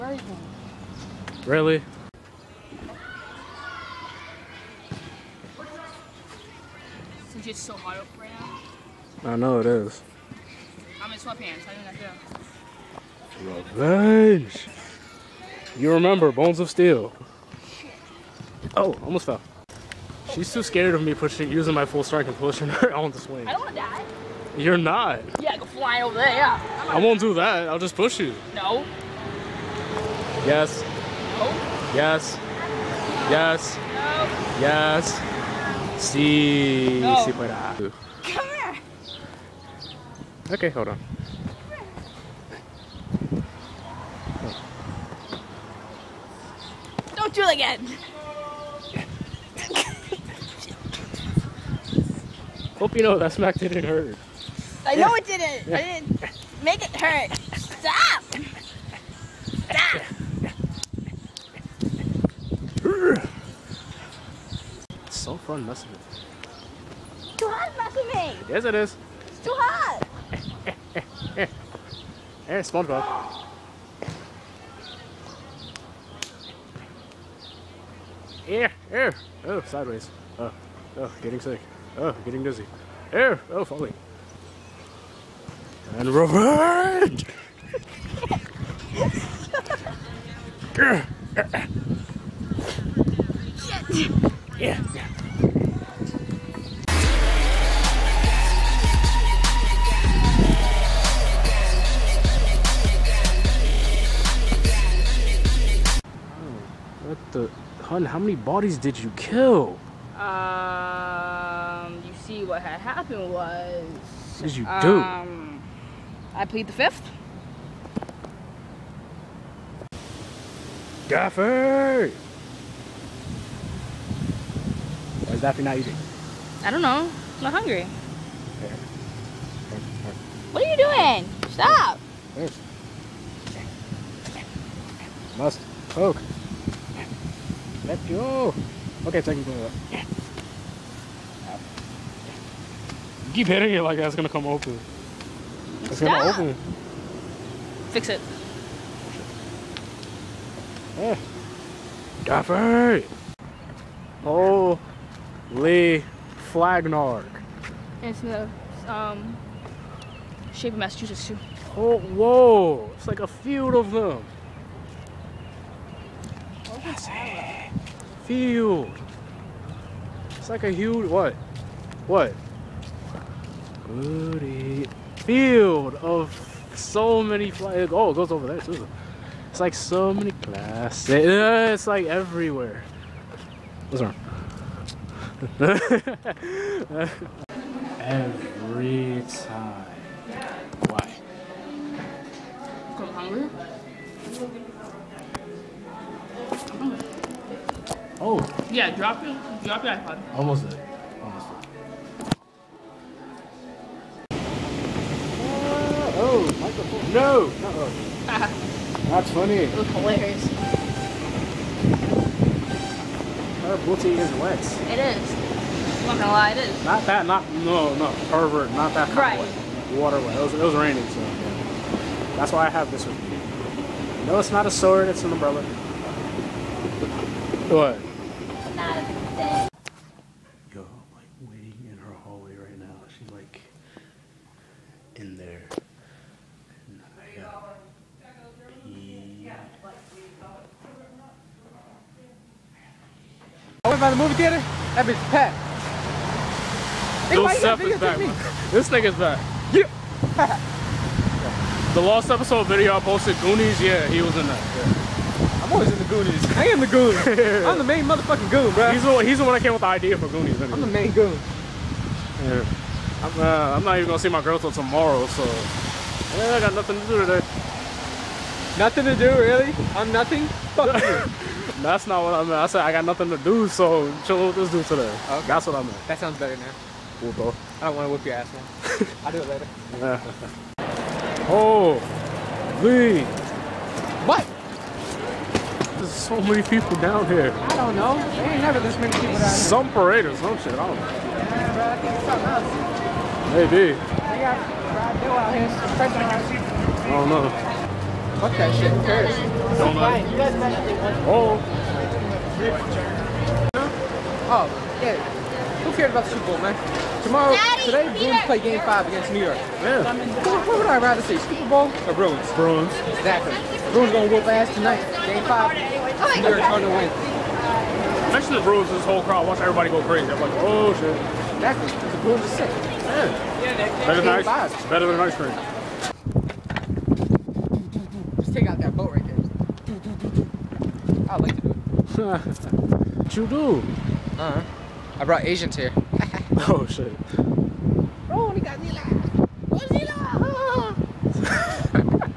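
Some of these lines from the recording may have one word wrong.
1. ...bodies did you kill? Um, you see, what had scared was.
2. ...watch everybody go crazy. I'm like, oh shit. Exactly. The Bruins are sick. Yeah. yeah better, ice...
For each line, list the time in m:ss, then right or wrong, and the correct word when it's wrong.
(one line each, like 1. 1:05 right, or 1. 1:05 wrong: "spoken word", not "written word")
1. 1:48 wrong: "happened", not "scared"
2. 5:19 right.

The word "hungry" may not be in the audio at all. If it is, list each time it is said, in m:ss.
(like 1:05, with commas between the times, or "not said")
2:07, 3:13.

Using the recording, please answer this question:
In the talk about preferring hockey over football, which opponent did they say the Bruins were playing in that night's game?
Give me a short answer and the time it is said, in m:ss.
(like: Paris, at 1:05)
New York, at 5:09.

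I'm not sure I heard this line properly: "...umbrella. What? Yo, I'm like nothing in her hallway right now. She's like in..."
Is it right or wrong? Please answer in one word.
wrong.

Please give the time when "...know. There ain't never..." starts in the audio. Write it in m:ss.
4:47.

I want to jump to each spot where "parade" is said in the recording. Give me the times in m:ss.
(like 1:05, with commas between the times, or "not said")
4:49.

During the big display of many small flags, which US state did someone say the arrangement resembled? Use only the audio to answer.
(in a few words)
Massachusetts.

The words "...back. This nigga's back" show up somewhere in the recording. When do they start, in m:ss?
4:07.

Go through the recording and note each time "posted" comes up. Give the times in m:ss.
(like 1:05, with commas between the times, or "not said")
4:13.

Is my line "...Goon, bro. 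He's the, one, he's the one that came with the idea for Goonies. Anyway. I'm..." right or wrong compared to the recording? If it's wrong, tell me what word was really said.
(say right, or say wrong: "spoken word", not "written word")
right.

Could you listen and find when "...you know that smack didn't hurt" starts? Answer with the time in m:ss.
0:52.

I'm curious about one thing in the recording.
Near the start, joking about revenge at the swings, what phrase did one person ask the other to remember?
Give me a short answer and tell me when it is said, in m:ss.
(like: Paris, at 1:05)
Bones of Steel, at 0:16.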